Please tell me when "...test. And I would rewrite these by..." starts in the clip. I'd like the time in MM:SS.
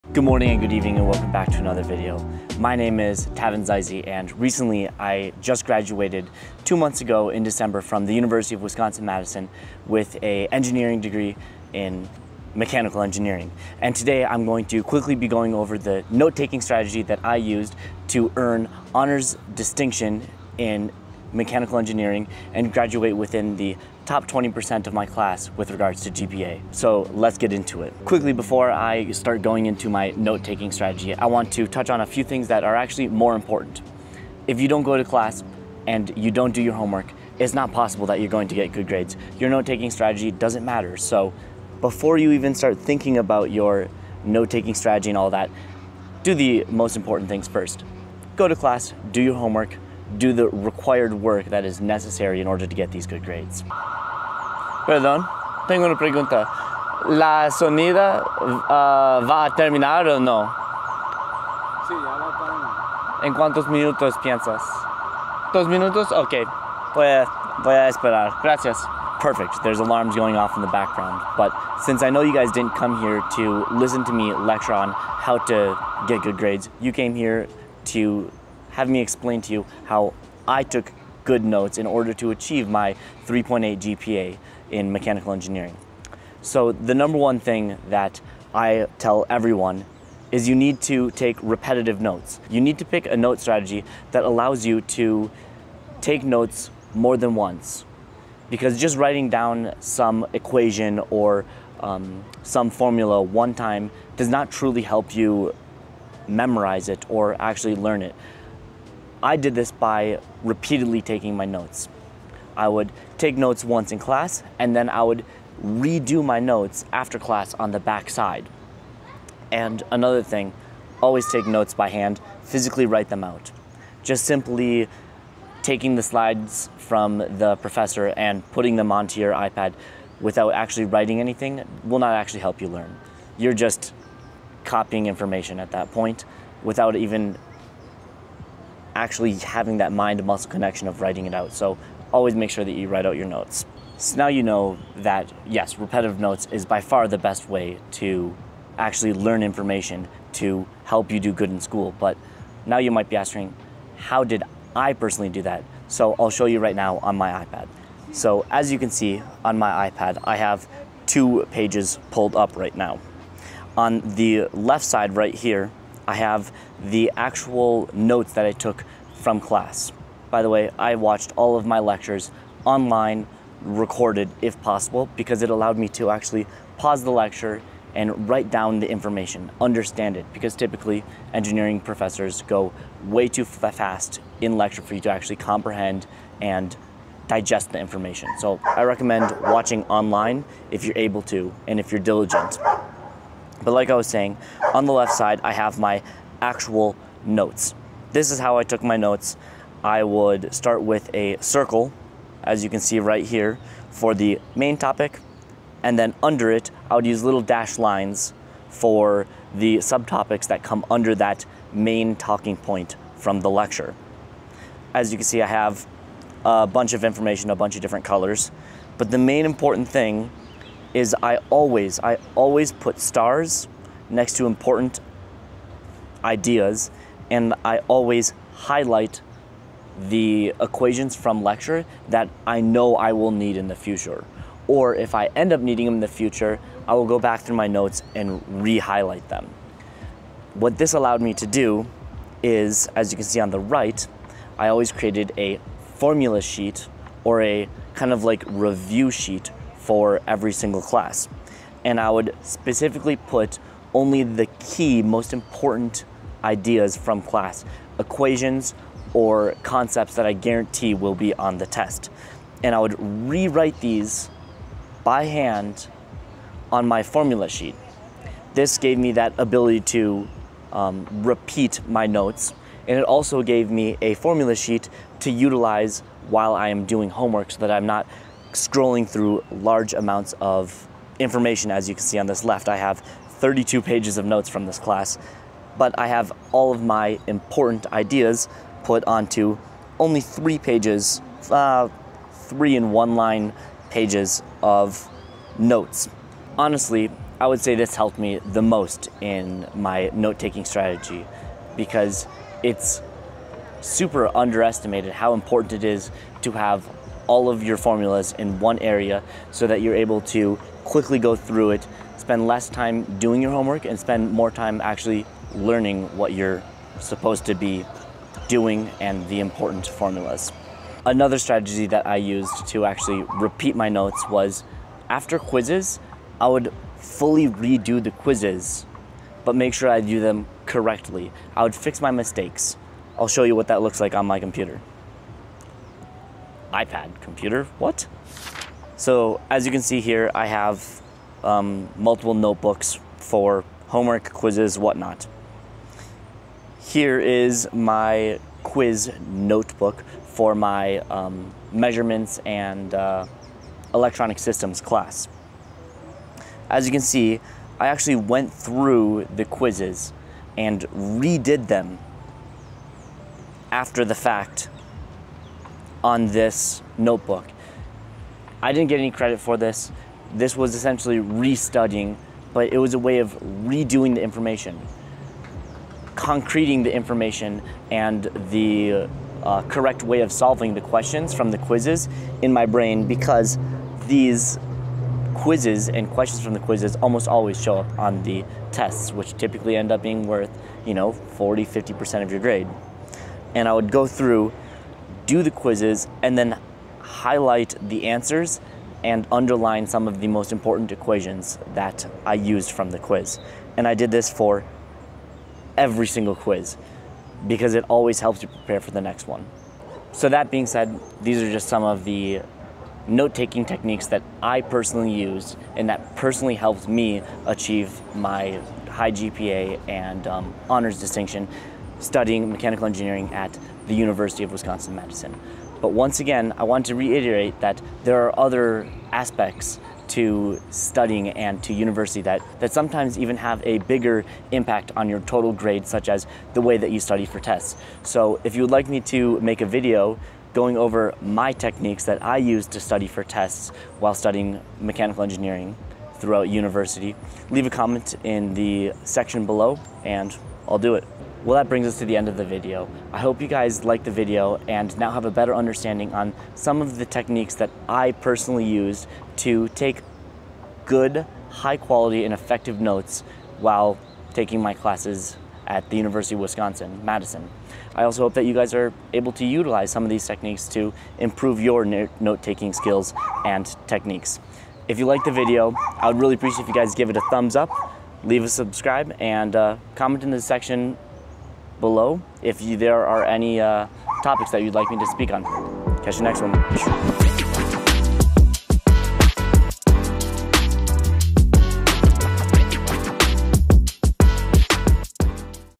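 04:21.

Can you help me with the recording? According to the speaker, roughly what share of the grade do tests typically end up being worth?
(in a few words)
40-50%.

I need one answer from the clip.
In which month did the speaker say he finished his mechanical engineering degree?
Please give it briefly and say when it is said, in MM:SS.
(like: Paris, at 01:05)
December, at 00:07.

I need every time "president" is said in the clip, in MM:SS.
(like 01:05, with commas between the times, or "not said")
not said.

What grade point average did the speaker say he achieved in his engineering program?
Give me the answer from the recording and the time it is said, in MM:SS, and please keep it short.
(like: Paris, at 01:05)
3.8, at 01:23.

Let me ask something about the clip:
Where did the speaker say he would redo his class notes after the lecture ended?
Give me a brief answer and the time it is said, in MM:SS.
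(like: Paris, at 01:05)
on the back side, at 01:57.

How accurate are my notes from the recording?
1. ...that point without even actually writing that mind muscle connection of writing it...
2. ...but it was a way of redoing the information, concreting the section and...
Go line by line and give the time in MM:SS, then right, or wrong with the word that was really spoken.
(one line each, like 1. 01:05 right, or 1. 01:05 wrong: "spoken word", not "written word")
1. 02:15 wrong: "having", not "writing"
2. 06:12 wrong: "information", not "section".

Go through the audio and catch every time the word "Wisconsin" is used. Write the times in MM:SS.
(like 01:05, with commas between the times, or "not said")
00:08, 07:04, 07:46.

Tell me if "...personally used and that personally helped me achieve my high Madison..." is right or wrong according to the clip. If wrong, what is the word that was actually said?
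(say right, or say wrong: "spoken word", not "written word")
wrong: "GPA", not "Madison".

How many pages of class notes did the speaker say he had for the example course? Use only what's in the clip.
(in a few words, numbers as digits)
32.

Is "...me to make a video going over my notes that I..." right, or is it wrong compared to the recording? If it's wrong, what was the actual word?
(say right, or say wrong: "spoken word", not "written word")
wrong: "techniques", not "notes".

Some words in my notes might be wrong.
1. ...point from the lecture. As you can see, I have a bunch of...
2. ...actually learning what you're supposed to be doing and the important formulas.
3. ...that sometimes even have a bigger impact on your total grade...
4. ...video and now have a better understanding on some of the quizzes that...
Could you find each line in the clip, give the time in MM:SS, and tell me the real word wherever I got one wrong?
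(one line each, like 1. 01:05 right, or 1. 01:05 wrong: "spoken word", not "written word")
1. 03:32 right
2. 05:14 right
3. 07:12 right
4. 07:34 wrong: "techniques", not "quizzes".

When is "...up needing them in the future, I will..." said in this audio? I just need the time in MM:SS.
03:55.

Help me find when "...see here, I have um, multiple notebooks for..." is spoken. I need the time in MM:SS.
05:39.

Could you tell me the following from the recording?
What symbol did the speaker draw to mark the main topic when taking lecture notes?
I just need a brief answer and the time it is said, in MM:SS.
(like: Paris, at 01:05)
a circle, at 03:21.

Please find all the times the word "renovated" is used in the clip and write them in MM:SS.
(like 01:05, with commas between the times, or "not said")
not said.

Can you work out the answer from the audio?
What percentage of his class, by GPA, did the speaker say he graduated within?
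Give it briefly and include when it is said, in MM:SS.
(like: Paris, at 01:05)
top 20%, at 00:24.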